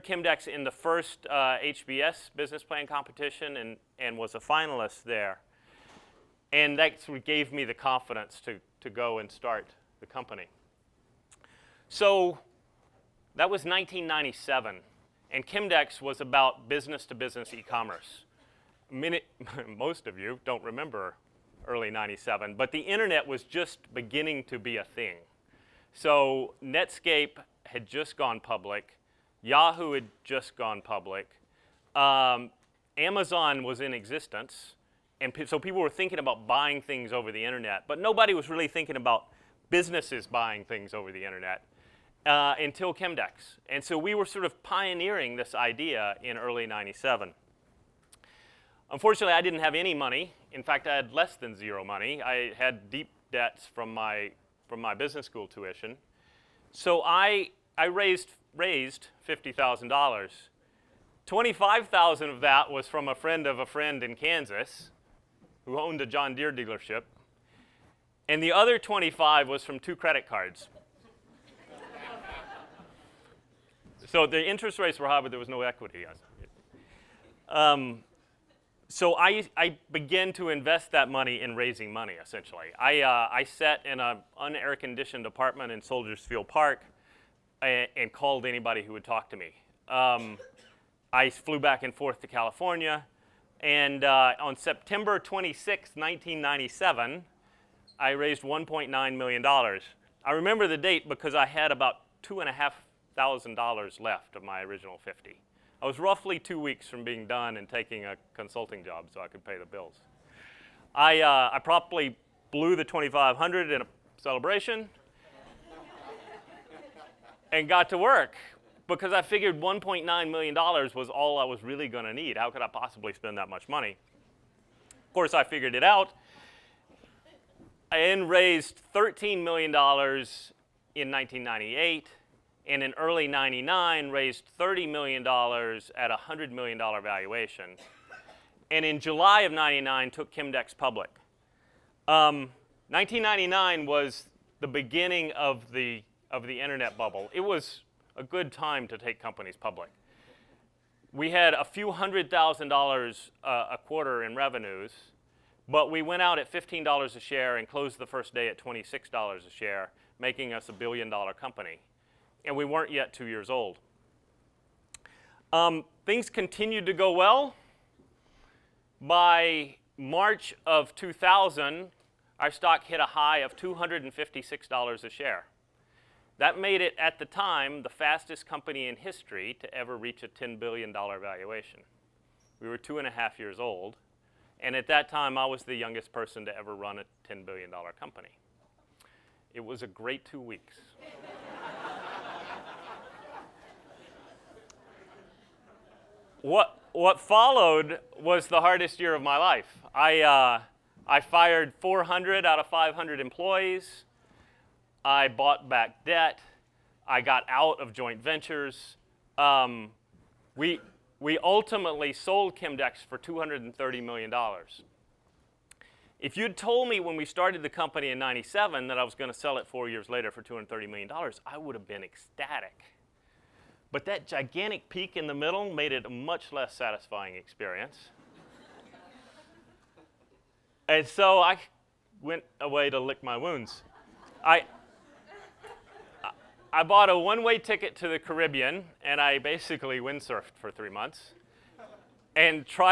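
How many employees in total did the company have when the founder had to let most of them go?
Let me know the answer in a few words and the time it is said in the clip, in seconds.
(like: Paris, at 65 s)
500, at 202 s.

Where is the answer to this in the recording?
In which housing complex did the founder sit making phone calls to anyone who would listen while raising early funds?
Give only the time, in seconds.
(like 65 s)
85 s.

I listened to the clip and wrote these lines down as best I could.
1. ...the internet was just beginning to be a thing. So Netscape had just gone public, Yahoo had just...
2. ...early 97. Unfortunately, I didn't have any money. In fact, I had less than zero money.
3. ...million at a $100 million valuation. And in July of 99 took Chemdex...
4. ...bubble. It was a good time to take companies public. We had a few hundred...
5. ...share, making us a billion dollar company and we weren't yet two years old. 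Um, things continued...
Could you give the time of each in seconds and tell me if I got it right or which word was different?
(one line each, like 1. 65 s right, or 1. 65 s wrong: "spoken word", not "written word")
1. 22 s right
2. 46 s right
3. 134 s right
4. 146 s right
5. 159 s right.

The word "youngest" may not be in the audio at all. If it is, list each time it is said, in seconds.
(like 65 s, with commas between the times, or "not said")
185 s.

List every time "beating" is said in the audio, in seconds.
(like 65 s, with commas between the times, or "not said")
not said.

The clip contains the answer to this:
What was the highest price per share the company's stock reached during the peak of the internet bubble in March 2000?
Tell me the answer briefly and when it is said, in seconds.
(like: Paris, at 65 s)
$256, at 173 s.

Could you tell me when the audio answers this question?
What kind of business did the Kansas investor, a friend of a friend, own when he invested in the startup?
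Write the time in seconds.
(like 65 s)
66 s.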